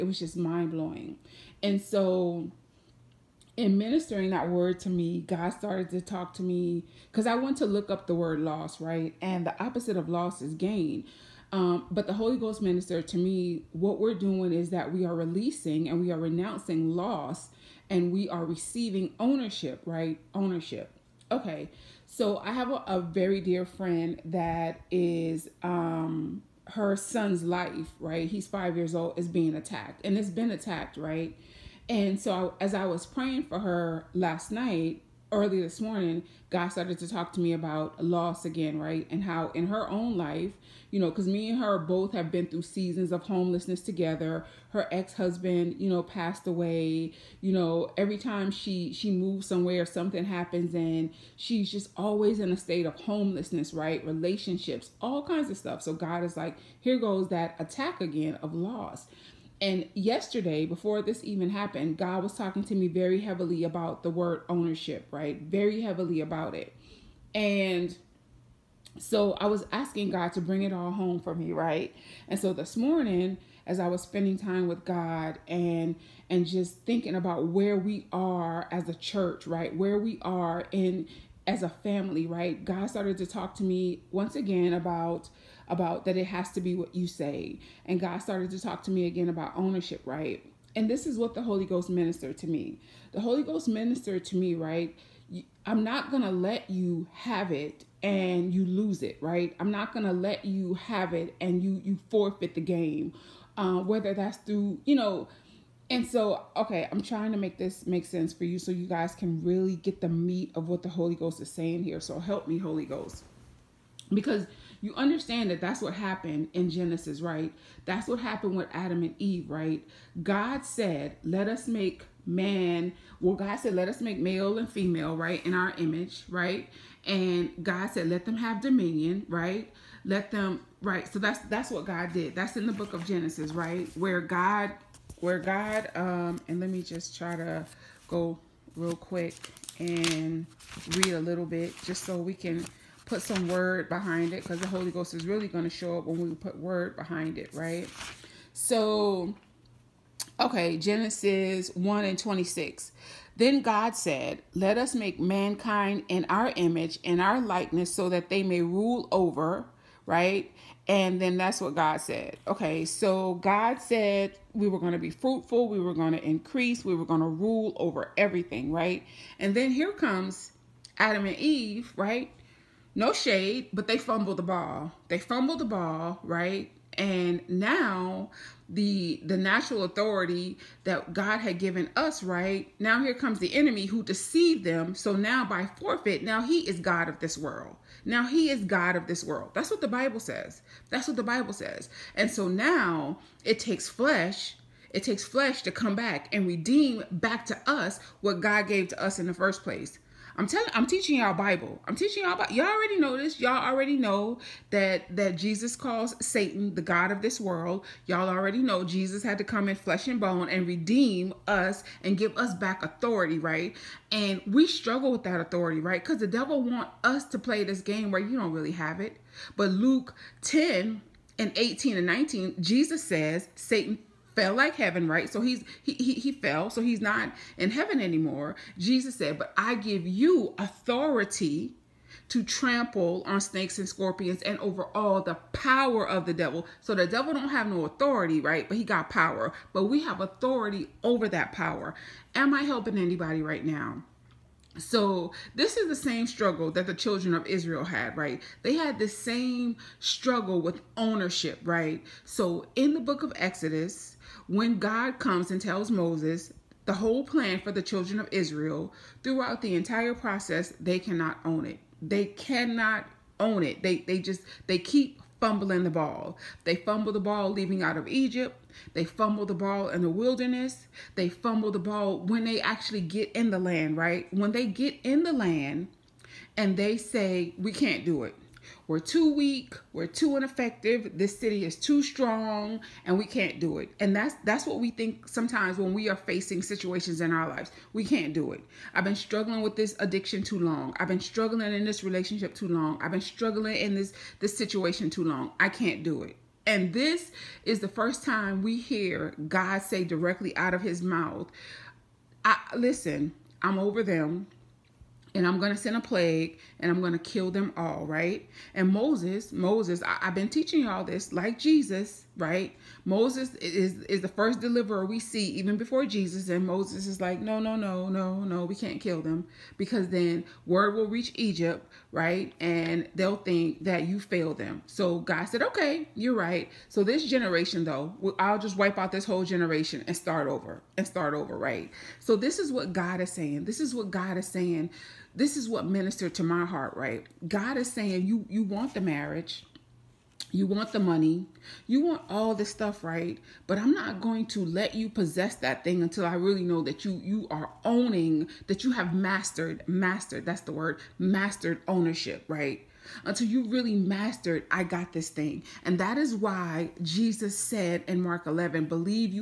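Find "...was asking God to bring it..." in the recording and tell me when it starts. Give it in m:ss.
1:09.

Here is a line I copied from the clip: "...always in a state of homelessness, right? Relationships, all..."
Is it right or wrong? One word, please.
right.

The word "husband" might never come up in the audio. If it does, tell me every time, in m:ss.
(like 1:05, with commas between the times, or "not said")
0:44.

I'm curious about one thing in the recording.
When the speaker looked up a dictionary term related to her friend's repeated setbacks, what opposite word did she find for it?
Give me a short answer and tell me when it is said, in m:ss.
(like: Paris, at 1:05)
gain, at 0:10.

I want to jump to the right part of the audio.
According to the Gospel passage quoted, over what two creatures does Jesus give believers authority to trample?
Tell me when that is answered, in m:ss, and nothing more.
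3:53.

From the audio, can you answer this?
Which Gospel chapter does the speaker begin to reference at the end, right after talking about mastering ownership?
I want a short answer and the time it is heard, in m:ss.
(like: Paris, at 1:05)
Mark 11, at 5:58.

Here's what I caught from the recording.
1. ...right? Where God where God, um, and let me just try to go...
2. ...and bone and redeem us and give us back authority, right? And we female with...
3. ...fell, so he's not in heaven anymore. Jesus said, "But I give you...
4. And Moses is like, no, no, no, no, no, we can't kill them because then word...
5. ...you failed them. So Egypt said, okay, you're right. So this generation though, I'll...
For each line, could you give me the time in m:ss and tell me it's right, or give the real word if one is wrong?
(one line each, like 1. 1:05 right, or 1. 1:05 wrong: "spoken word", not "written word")
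1. 2:13 right
2. 3:30 wrong: "struggle", not "female"
3. 3:46 right
4. 5:16 right
5. 5:24 wrong: "God", not "Egypt".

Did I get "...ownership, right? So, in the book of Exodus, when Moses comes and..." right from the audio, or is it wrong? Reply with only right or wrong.
wrong.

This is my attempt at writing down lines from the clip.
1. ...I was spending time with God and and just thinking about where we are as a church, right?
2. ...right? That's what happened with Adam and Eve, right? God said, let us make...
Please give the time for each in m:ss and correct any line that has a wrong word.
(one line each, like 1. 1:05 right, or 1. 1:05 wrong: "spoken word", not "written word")
1. 1:13 right
2. 1:57 right.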